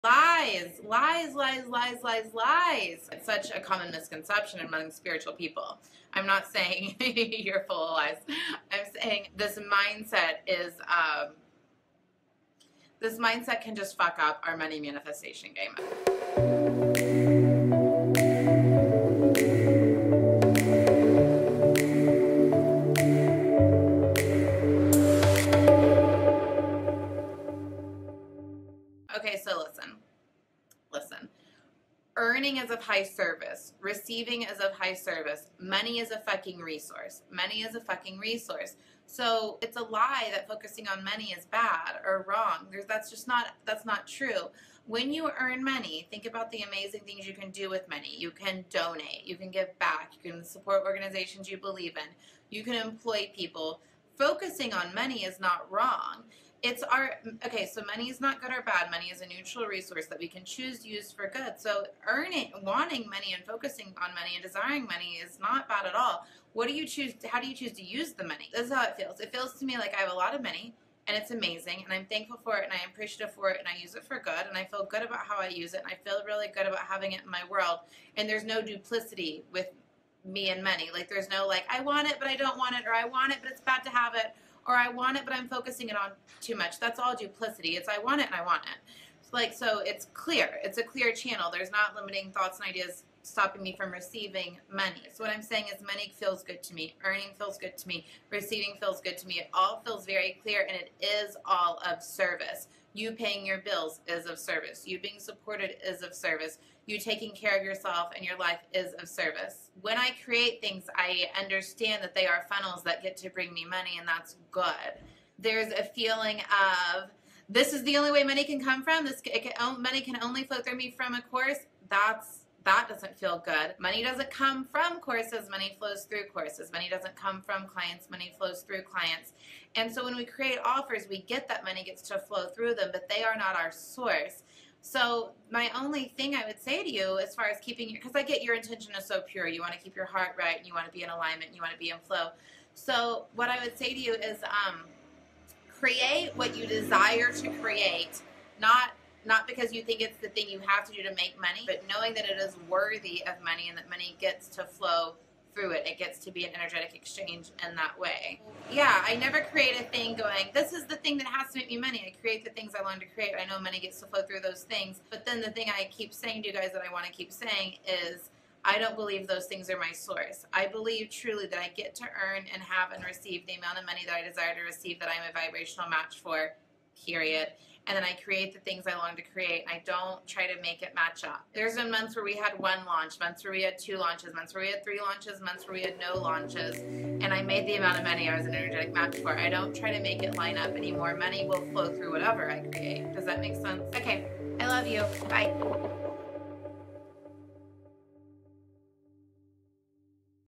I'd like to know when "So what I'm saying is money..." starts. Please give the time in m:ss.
1:35.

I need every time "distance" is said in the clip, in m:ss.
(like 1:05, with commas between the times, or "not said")
not said.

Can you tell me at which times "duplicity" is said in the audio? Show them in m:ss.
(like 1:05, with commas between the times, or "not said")
1:18, 1:27.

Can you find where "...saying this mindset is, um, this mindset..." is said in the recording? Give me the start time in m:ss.
0:09.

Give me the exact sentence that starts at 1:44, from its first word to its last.
You being supported is of service.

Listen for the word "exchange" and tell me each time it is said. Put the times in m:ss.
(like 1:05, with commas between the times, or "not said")
2:36.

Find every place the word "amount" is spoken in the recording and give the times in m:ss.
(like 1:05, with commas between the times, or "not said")
2:53, 3:07.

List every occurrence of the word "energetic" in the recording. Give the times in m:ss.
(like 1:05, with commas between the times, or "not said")
2:36, 3:08.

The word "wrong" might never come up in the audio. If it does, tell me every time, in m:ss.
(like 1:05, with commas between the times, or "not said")
0:42, 0:55.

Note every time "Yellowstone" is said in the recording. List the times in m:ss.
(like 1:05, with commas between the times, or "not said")
not said.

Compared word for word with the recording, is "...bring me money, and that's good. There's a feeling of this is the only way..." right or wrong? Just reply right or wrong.
right.